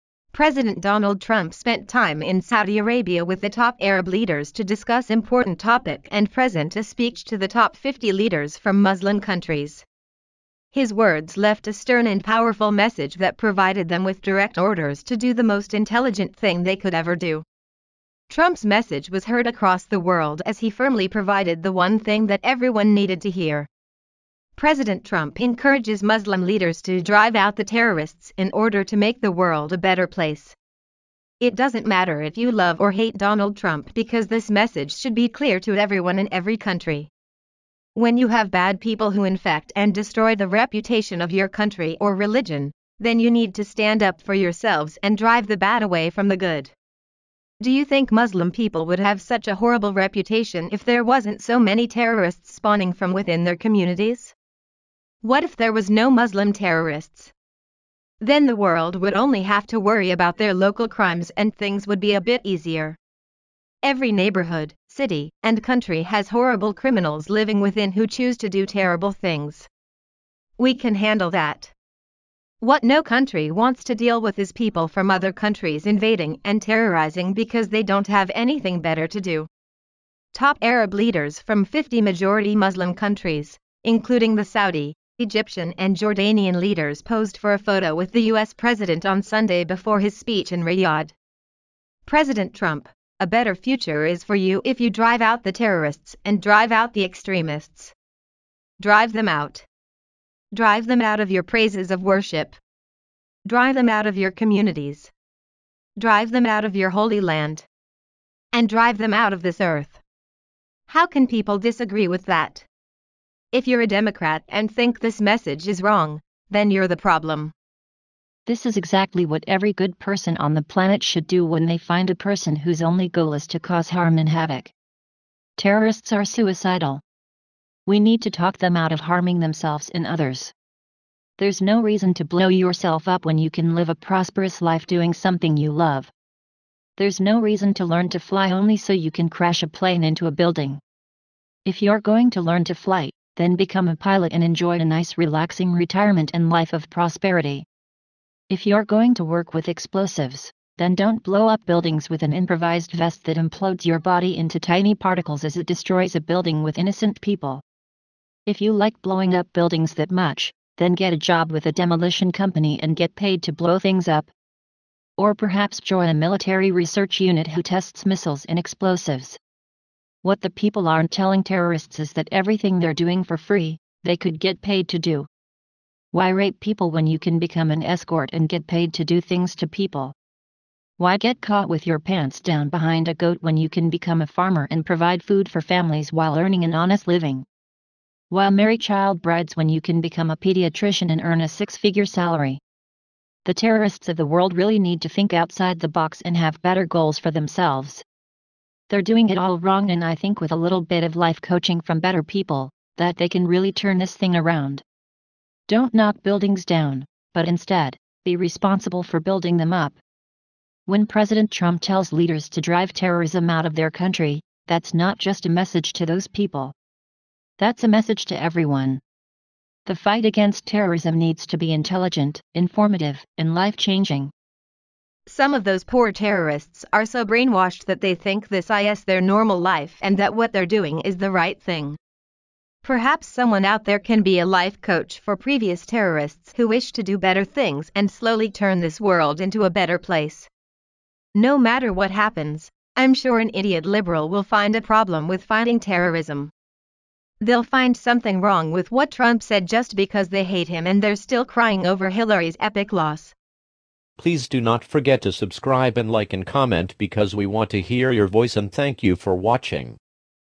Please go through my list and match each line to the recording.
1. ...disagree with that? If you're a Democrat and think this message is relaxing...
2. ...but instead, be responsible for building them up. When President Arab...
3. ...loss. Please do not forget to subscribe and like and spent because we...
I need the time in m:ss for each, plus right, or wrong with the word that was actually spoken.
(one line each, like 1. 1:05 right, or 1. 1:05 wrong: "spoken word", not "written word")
1. 1:51 wrong: "wrong", not "relaxing"
2. 3:27 wrong: "Trump", not "Arab"
3. 4:12 wrong: "comment", not "spent".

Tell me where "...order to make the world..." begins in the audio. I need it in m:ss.
0:28.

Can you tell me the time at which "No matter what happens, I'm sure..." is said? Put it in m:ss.
4:01.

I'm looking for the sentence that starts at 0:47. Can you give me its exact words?
Do you think Muslim people would have such a horrible reputation if there wasn't so many terrorists spawning from within their communities?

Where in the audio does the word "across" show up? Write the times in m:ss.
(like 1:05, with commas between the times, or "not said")
0:19.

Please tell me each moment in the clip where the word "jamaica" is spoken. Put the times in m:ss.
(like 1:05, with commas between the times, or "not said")
not said.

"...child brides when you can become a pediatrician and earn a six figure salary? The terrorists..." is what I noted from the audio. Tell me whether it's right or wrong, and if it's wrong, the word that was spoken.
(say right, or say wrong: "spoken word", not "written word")
right.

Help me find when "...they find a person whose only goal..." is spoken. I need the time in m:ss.
2:01.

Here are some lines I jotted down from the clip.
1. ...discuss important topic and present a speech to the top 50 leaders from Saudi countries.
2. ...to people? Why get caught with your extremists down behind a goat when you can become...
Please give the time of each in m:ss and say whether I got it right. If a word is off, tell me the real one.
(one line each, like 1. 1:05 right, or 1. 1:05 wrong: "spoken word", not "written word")
1. 0:04 wrong: "Muslim", not "Saudi"
2. 2:59 wrong: "pants", not "extremists".